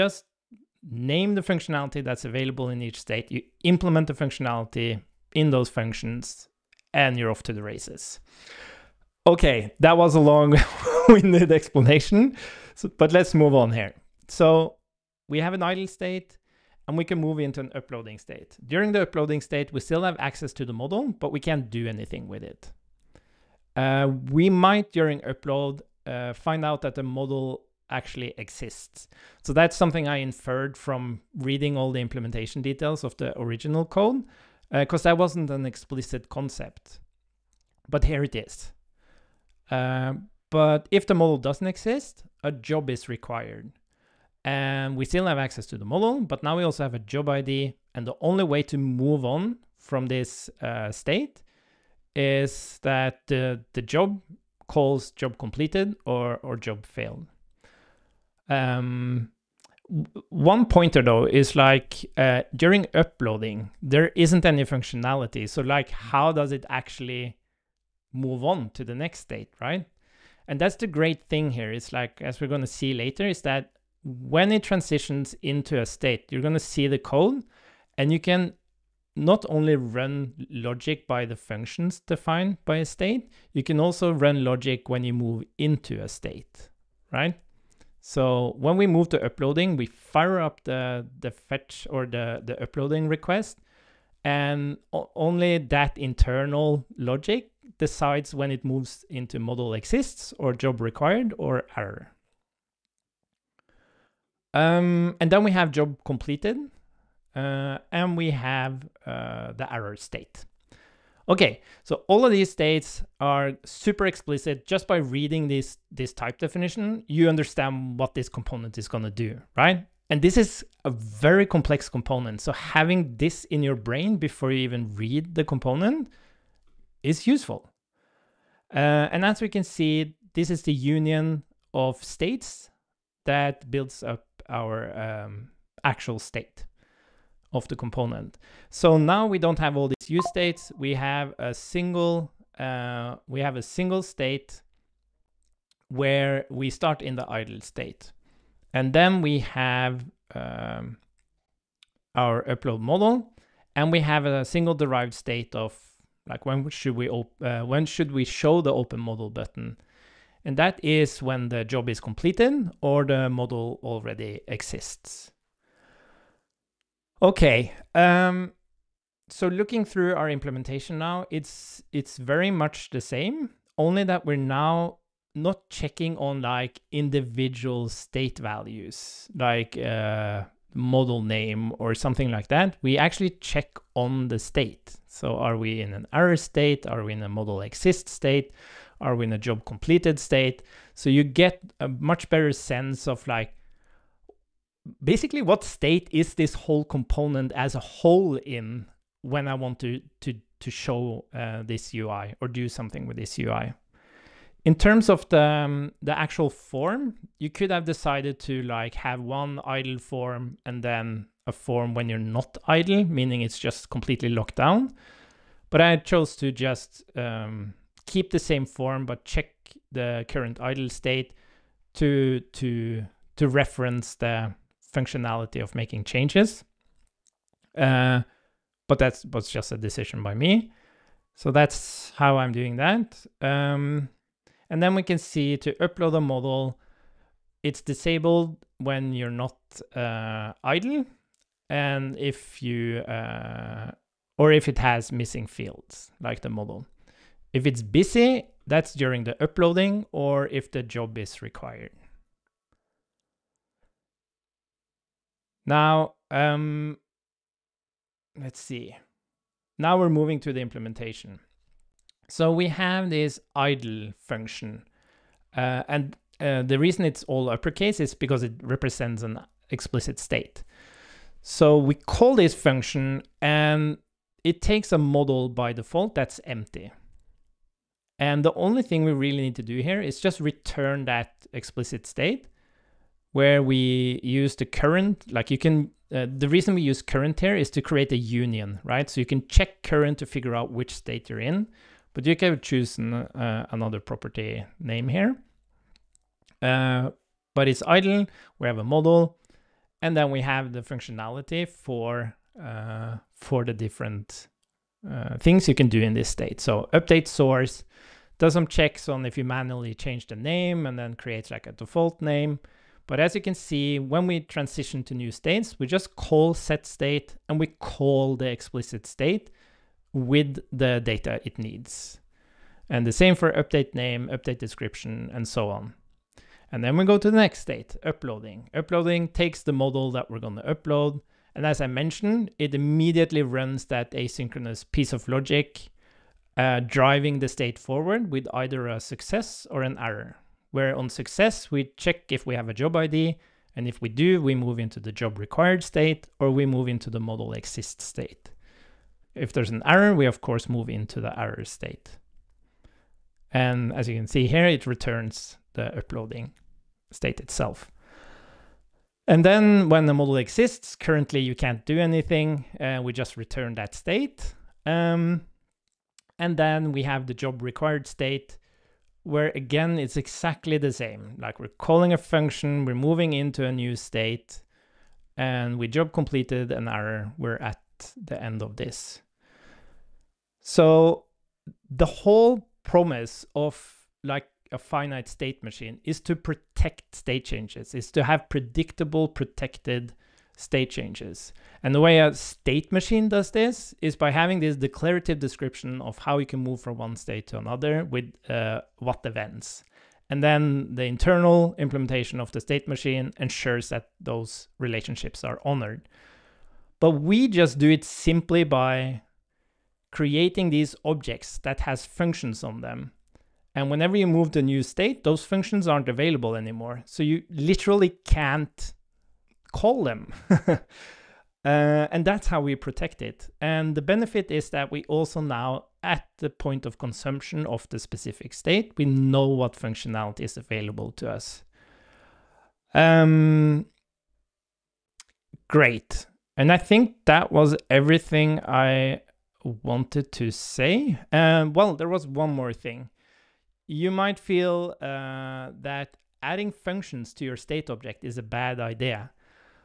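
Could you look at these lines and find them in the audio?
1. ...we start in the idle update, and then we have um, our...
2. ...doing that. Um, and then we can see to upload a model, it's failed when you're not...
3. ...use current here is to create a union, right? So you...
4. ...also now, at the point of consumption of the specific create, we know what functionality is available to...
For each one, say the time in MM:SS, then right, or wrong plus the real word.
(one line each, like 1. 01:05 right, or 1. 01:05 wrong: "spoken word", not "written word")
1. 02:26 wrong: "state", not "update"
2. 03:52 wrong: "disabled", not "failed"
3. 04:46 right
4. 07:05 wrong: "state", not "create".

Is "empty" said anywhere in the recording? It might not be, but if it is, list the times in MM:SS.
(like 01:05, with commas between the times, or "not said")
04:36.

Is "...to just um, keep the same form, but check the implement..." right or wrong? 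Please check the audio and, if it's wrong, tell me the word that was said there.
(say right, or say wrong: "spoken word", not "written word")
wrong: "current", not "implement".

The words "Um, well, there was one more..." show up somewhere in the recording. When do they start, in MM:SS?
07:21.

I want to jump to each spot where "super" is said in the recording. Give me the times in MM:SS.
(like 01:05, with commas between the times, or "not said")
01:53.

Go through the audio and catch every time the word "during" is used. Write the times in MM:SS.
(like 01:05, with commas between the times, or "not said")
00:18, 00:24, 01:02, 04:08.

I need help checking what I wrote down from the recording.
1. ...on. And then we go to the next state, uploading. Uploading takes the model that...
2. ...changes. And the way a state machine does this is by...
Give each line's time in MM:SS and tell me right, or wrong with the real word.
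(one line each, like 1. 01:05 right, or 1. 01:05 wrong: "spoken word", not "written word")
1. 05:25 right
2. 06:30 right.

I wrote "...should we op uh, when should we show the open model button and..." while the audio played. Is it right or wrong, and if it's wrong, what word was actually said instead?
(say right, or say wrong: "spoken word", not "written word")
right.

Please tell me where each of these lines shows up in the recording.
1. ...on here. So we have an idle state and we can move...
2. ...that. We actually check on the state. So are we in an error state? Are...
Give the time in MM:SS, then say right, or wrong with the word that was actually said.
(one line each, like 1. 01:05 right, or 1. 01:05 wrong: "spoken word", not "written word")
1. 00:13 right
2. 03:02 right.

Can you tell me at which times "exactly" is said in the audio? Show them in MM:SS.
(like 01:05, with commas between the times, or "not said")
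06:10.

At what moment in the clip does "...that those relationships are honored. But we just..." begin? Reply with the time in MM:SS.
06:43.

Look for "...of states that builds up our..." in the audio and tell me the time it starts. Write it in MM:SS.
02:11.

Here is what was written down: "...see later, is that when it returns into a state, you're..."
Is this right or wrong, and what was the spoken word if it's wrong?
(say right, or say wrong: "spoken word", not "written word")
wrong: "transitions", not "returns".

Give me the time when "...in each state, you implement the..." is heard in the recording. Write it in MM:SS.
00:02.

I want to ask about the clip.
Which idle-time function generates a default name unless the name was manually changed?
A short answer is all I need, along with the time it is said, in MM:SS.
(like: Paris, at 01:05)
update source, at 05:06.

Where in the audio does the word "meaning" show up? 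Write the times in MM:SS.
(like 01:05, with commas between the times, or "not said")
03:33.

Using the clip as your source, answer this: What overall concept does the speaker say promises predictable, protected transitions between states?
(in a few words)
finite state machine.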